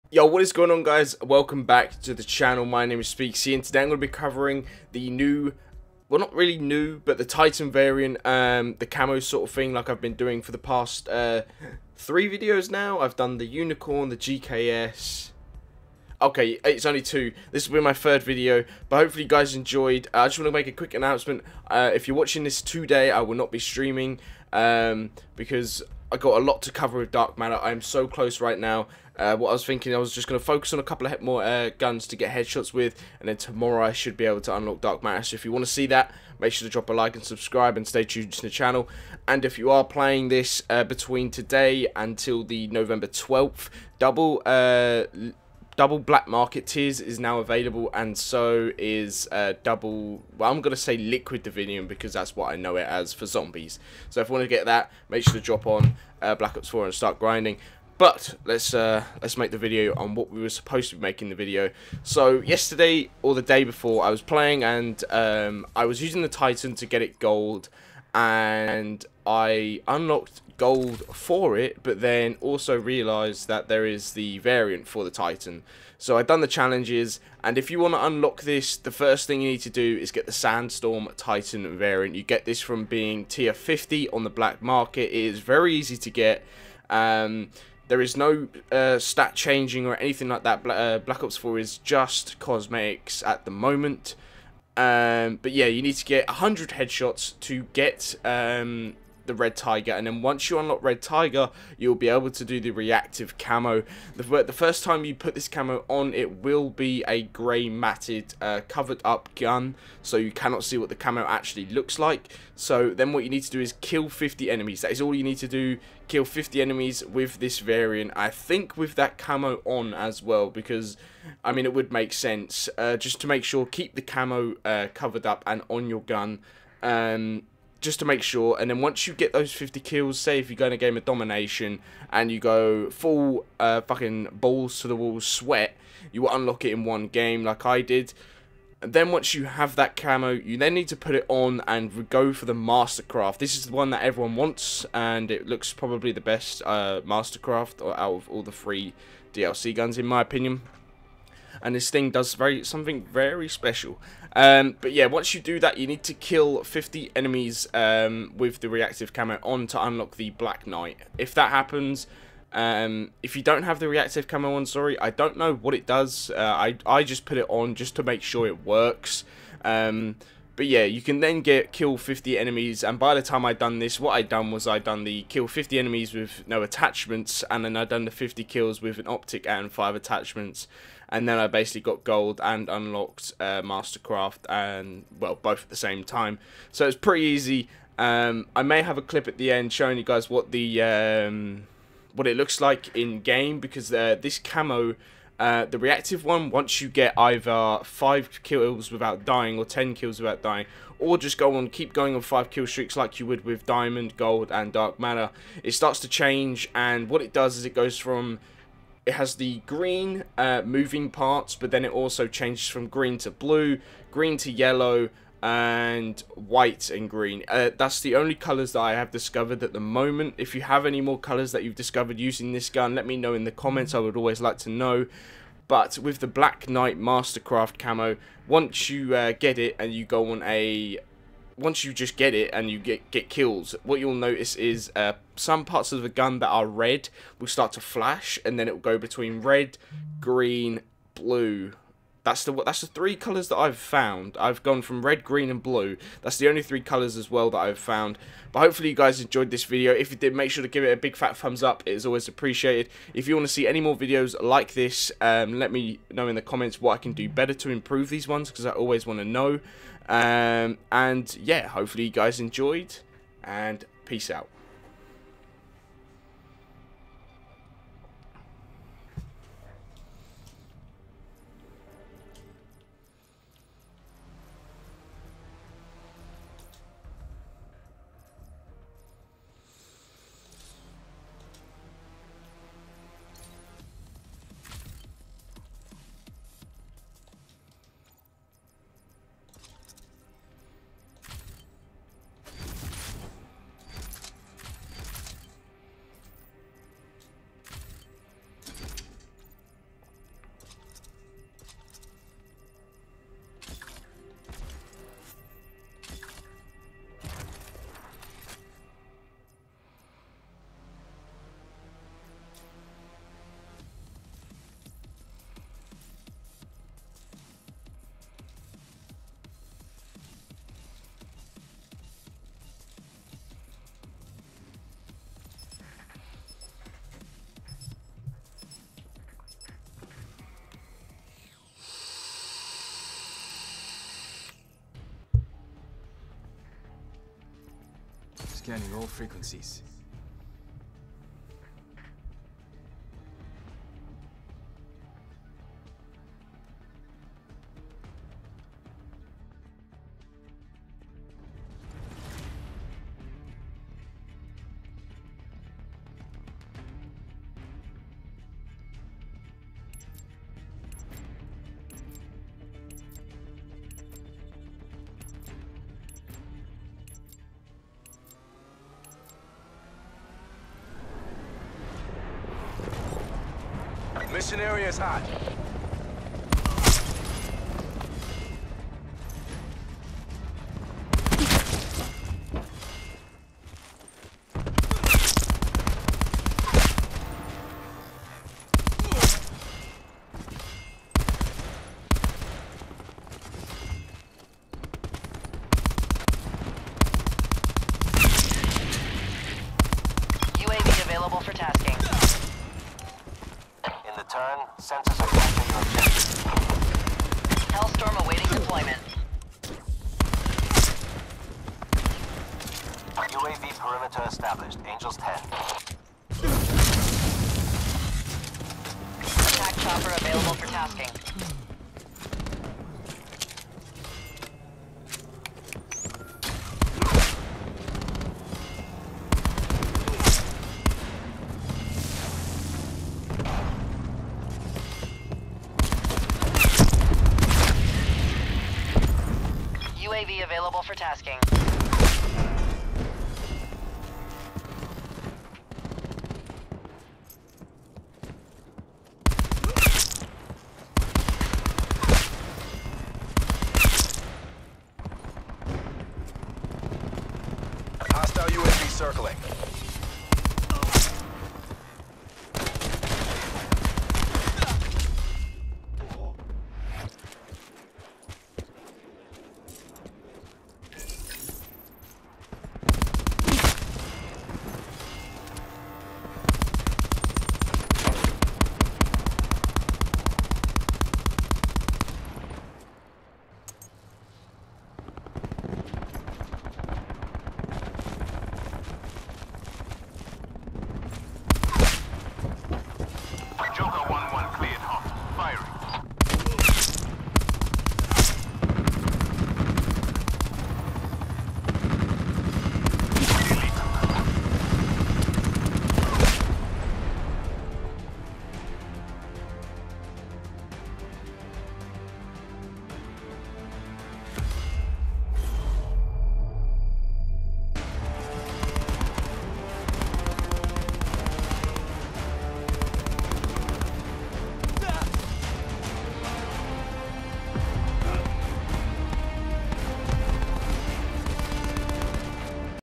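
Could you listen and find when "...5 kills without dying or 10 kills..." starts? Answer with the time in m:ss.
3:17.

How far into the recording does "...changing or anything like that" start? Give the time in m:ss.
1:29.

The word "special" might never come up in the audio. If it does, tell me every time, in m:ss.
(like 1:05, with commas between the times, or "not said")
2:33.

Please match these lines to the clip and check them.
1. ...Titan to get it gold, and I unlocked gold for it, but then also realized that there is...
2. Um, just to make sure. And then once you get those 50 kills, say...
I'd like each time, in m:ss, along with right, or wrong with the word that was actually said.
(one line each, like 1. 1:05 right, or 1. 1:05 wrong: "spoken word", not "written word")
1. 1:06 right
2. 2:06 right.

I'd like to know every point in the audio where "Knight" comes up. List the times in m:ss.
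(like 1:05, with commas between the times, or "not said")
2:40, 3:46.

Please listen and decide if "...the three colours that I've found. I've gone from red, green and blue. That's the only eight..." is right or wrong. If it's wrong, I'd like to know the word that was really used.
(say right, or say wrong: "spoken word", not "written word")
wrong: "three", not "eight".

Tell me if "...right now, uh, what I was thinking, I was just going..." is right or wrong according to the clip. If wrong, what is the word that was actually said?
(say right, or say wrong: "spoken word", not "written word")
right.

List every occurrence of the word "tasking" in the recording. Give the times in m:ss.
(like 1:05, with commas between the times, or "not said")
6:41, 7:00, 7:20.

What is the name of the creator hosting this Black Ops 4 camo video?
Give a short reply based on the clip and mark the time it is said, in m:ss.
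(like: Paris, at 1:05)
Speakzy, at 0:03.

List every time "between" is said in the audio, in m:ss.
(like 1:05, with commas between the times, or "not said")
0:40, 3:58.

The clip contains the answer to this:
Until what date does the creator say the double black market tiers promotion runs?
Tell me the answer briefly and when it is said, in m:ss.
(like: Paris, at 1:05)
November 12th, at 0:42.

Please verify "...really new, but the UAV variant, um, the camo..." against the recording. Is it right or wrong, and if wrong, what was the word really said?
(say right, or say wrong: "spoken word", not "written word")
wrong: "Titan", not "UAV".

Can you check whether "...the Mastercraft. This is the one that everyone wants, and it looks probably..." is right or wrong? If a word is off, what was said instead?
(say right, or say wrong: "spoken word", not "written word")
right.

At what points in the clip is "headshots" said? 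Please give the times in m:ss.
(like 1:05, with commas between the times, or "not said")
0:32, 1:36.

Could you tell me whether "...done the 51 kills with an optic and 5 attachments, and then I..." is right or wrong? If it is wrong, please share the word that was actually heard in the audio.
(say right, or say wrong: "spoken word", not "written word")
wrong: "50", not "51".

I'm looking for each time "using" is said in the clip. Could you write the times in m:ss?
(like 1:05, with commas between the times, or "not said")
1:06, 3:42.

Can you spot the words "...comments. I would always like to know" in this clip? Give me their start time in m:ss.
3:43.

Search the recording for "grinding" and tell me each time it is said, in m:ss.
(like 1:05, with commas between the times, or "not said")
0:57.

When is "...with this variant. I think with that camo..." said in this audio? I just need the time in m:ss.
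1:57.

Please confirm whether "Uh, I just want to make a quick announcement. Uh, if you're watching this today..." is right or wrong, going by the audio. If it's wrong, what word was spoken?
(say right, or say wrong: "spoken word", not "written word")
right.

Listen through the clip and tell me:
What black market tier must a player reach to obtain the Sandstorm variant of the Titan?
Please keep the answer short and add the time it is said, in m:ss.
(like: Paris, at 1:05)
50, at 1:23.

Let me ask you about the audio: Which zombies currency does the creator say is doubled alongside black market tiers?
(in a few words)
Liquid divinium.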